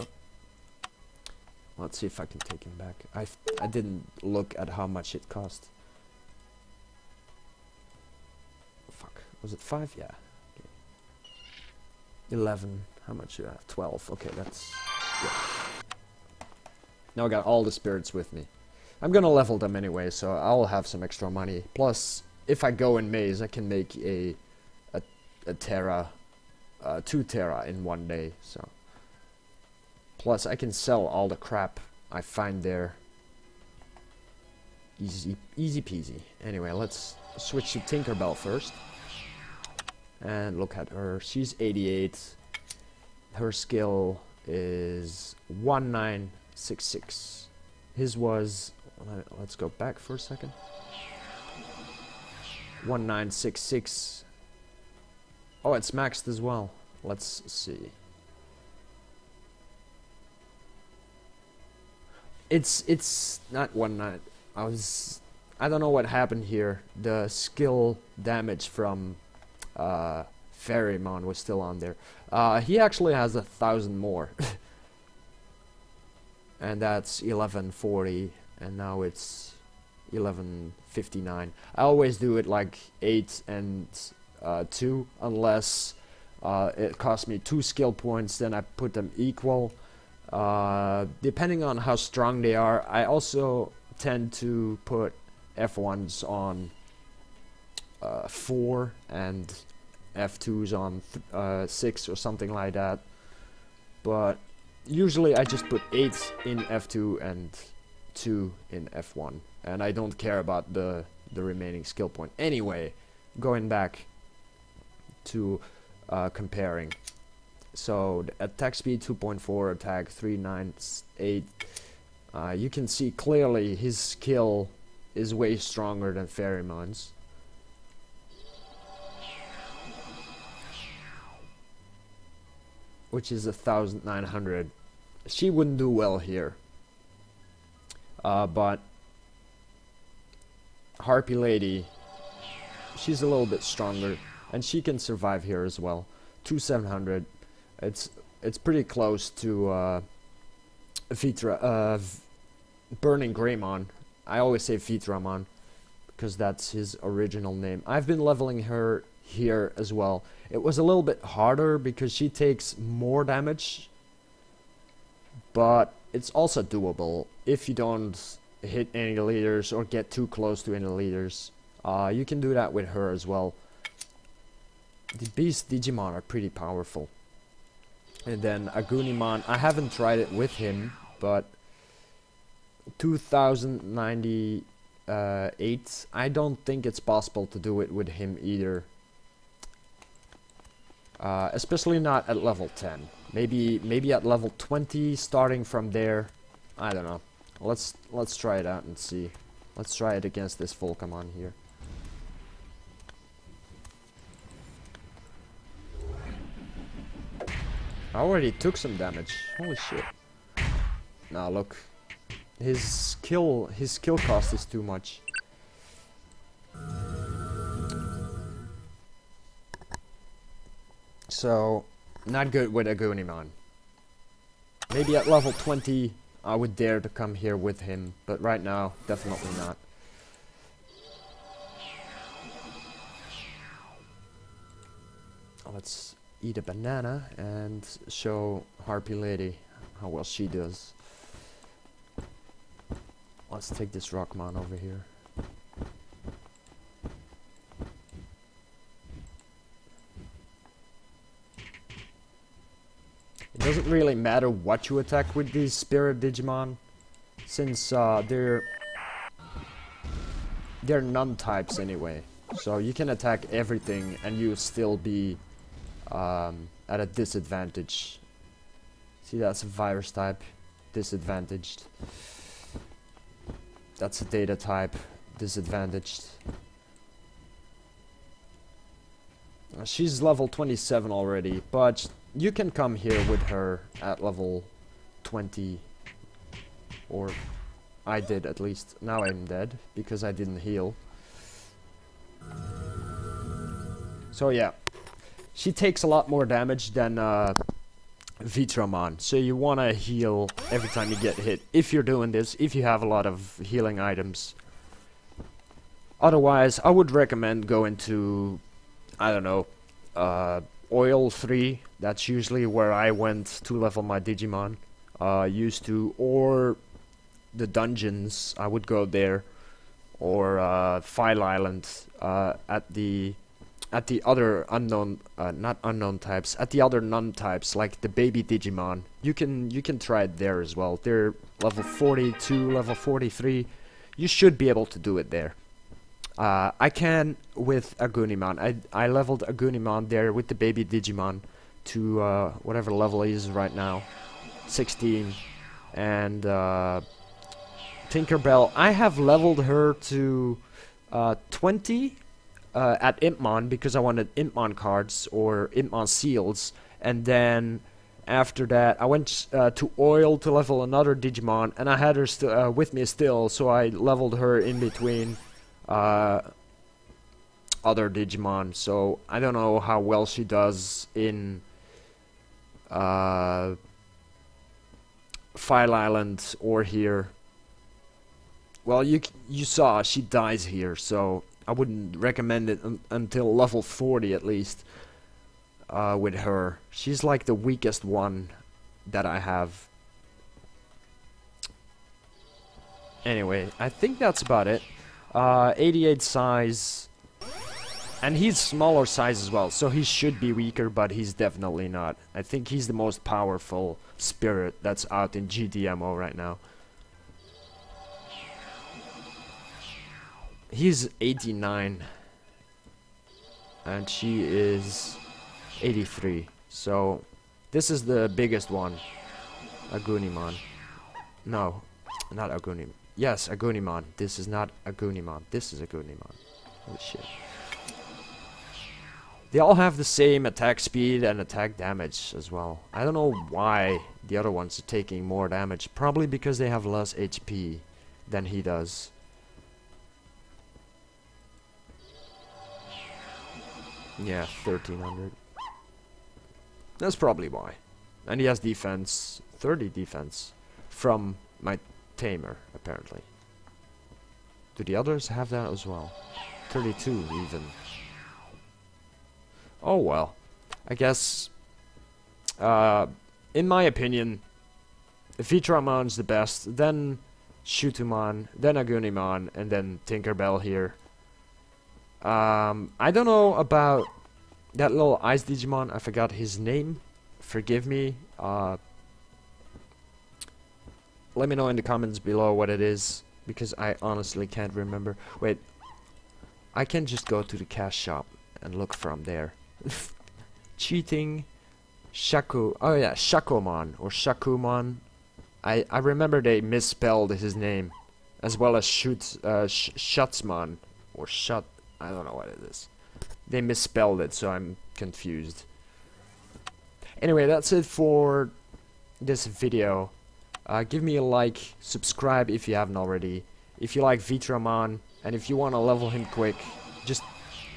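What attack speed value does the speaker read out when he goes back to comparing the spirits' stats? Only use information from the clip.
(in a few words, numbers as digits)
2.4.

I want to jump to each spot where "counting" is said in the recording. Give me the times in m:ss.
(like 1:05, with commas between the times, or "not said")
not said.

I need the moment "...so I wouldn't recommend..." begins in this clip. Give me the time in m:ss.
6:20.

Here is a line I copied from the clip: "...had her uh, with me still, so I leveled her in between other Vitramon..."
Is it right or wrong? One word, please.
wrong.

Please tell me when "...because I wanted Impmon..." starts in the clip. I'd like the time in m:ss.
5:53.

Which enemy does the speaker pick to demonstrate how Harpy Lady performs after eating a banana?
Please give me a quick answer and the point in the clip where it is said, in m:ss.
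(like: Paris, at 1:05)
Rockmon, at 4:04.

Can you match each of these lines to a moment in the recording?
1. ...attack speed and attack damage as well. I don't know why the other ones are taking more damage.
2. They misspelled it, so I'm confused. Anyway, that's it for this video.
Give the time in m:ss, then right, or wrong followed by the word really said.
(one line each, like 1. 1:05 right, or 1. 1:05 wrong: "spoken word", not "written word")
1. 7:10 right
2. 8:23 right.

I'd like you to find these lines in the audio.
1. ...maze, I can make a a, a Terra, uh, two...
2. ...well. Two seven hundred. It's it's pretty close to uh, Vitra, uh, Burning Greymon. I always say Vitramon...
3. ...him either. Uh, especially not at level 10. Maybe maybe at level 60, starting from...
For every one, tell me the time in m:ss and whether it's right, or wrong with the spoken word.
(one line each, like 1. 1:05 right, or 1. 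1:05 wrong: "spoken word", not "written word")
1. 0:23 right
2. 2:25 right
3. 3:08 wrong: "20", not "60".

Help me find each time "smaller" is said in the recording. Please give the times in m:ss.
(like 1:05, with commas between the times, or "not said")
6:38.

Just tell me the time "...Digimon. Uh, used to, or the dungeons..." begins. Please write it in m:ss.
5:14.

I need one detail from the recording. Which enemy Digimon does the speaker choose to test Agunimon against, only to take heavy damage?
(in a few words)
Volcamon.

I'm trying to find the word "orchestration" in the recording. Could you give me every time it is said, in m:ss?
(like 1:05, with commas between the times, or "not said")
not said.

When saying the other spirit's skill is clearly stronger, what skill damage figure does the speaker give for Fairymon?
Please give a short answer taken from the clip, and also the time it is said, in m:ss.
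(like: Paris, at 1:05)
1,900, at 2:13.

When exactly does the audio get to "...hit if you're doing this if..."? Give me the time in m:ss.
5:01.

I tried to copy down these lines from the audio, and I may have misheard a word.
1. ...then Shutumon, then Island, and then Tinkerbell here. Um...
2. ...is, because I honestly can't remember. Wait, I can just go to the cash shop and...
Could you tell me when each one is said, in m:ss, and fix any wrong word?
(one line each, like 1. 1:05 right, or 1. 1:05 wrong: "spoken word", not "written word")
1. 7:46 wrong: "Agunimon", not "Island"
2. 8:02 right.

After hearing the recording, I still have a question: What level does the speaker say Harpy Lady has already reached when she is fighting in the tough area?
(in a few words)
27.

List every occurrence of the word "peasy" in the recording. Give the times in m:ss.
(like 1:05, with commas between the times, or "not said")
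0:35.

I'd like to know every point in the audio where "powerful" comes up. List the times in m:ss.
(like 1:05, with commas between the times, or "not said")
2:56, 6:43.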